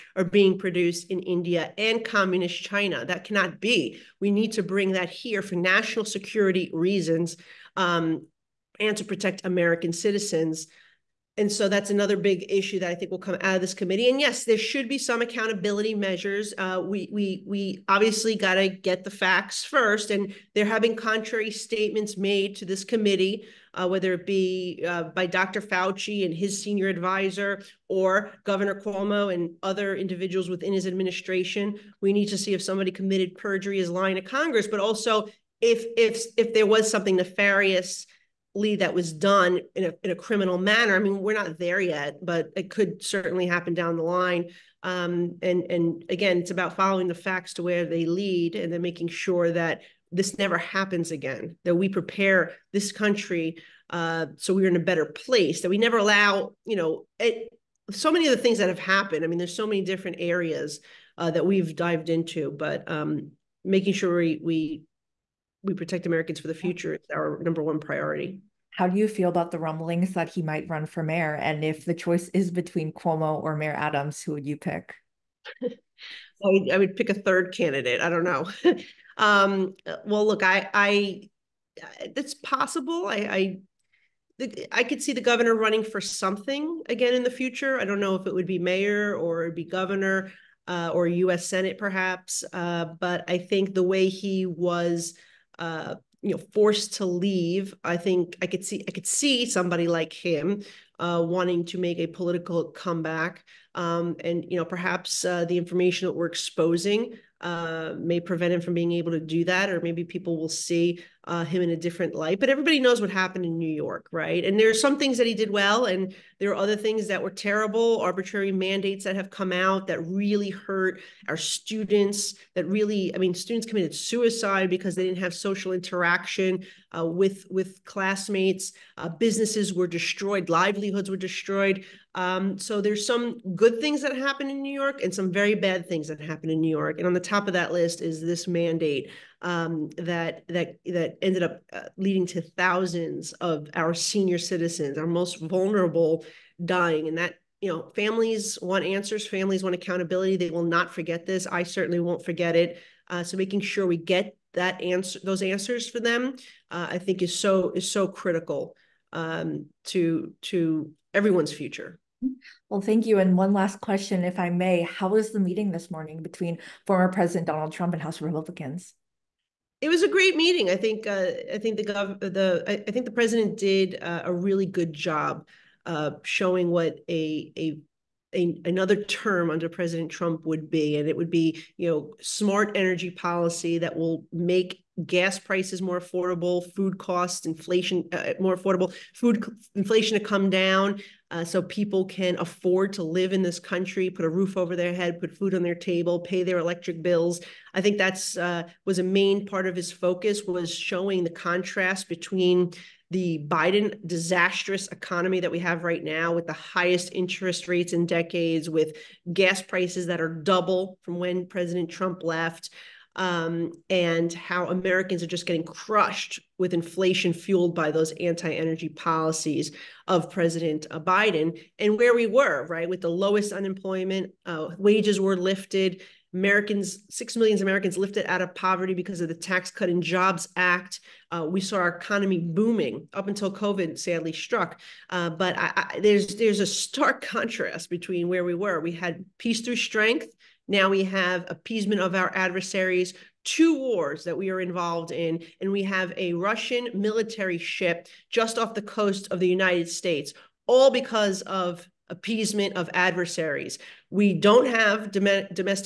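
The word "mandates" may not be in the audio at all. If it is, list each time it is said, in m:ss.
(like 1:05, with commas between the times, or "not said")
1:58, 2:18.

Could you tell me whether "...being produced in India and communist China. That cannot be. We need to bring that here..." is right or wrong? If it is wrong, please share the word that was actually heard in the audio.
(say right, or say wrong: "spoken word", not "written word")
right.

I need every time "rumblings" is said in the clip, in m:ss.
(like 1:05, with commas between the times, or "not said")
1:09.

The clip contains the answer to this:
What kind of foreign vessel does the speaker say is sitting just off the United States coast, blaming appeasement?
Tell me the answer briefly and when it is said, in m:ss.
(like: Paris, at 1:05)
Russian military ship, at 4:06.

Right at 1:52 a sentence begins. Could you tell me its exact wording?
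But everybody knows what happened in New York, right?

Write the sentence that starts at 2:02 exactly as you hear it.
That really, I mean, students committed suicide because they didn't have social interaction uh, with with classmates.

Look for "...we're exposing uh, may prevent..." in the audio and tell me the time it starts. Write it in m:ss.
1:46.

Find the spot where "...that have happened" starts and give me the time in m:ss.
0:58.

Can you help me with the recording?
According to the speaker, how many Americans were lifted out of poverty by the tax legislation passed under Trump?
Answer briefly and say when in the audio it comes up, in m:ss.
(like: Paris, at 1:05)
6 million, at 3:47.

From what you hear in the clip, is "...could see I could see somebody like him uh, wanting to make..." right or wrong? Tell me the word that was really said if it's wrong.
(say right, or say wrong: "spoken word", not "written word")
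right.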